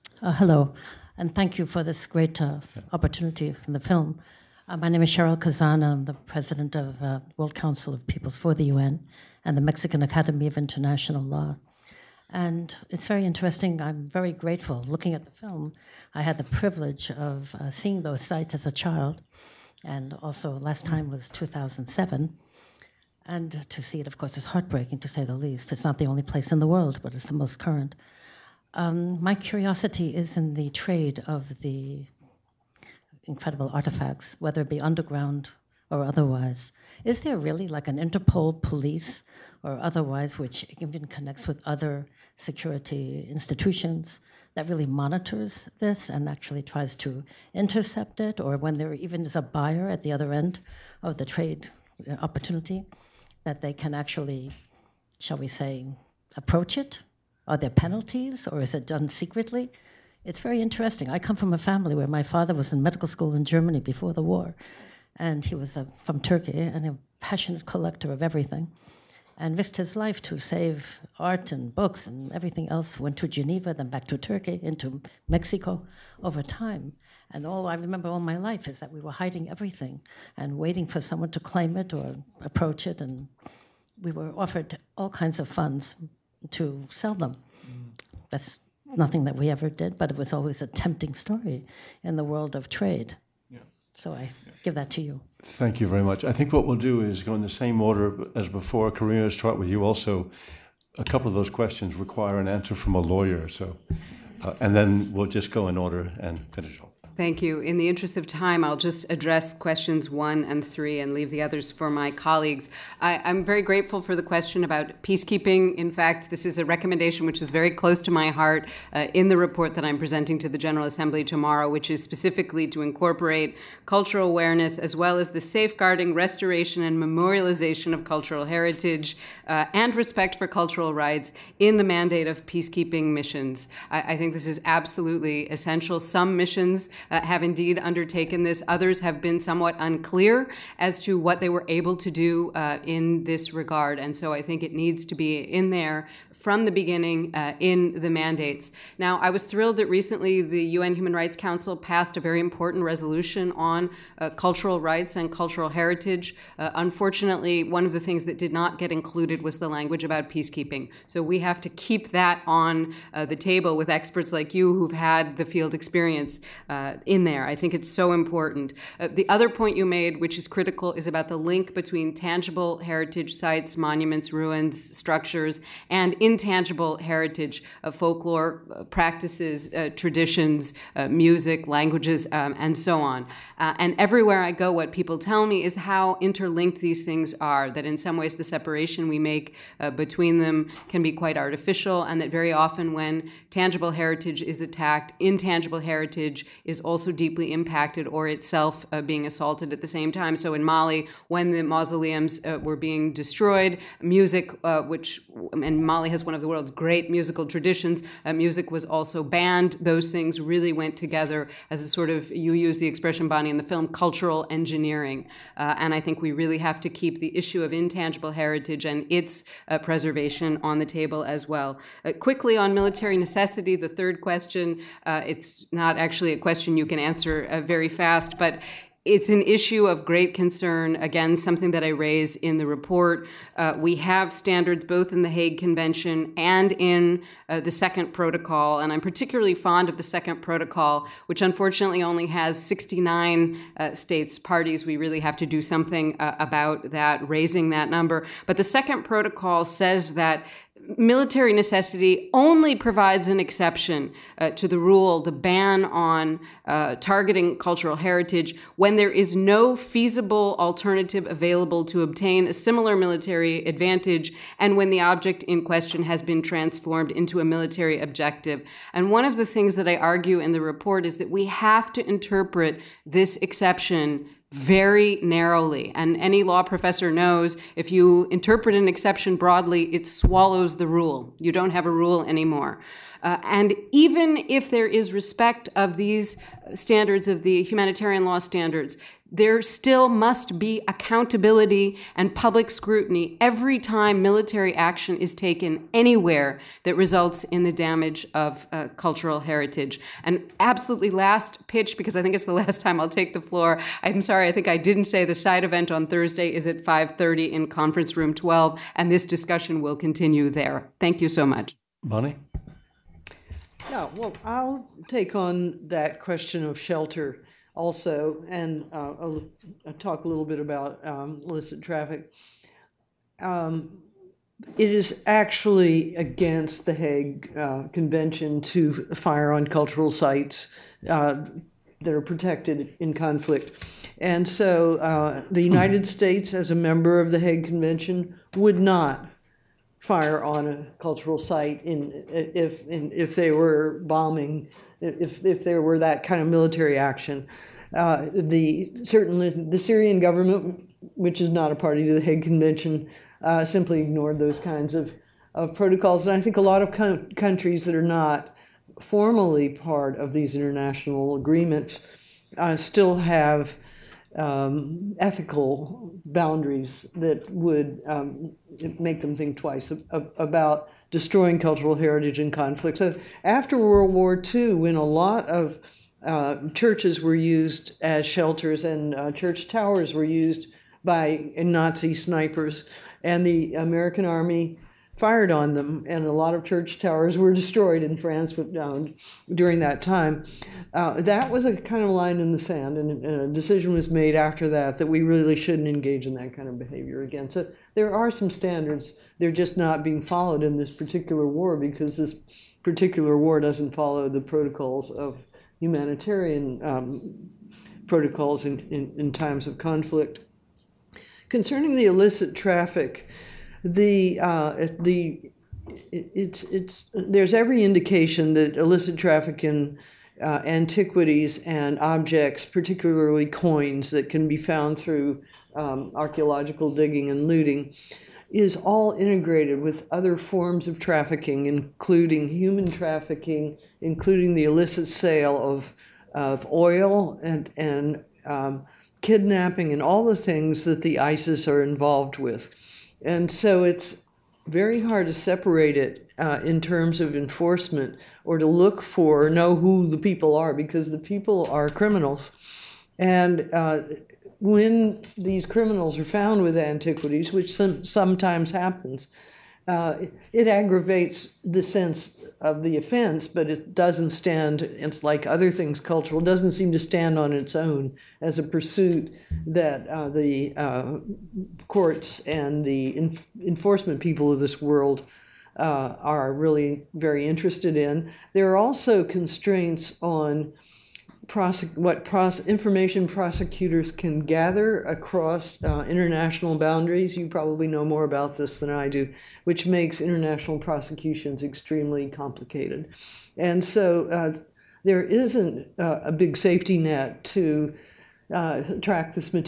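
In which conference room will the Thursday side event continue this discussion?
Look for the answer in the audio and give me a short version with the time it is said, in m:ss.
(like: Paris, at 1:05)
Conference room 12, at 5:07.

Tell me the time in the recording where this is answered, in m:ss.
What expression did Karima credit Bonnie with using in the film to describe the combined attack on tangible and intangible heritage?
3:33.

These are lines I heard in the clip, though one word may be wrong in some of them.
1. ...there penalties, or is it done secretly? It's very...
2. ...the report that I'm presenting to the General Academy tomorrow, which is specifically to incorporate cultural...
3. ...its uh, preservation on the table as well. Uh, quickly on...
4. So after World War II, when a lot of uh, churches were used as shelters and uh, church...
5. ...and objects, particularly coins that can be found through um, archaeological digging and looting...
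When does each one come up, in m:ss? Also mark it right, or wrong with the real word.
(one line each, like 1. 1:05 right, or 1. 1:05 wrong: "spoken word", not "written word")
1. 0:57 right
2. 1:59 wrong: "Assembly", not "Academy"
3. 3:39 right
4. 6:12 right
5. 7:01 right.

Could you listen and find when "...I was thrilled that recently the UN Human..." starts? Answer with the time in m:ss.
2:29.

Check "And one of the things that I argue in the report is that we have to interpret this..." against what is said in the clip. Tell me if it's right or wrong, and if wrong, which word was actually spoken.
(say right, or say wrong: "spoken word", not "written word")
right.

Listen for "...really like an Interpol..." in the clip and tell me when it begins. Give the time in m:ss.
0:37.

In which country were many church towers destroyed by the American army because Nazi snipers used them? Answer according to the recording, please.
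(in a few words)
France.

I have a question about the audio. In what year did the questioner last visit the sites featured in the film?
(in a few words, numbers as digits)
2007.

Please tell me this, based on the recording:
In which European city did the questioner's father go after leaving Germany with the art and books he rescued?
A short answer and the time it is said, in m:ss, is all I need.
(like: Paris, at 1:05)
Geneva, at 1:13.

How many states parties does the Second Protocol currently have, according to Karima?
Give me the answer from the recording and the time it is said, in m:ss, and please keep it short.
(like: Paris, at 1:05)
69, at 4:02.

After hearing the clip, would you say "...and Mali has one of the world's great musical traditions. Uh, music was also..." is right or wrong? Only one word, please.
right.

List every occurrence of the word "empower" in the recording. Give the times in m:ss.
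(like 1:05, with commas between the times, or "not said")
not said.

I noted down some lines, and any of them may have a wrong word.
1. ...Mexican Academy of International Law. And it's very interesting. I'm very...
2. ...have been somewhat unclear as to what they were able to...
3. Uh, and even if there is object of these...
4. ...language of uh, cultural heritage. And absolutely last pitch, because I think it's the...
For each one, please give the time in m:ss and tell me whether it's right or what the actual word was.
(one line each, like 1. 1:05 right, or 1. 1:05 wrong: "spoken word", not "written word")
1. 0:09 right
2. 2:19 right
3. 4:43 wrong: "respect", not "object"
4. 4:57 wrong: "damage", not "language".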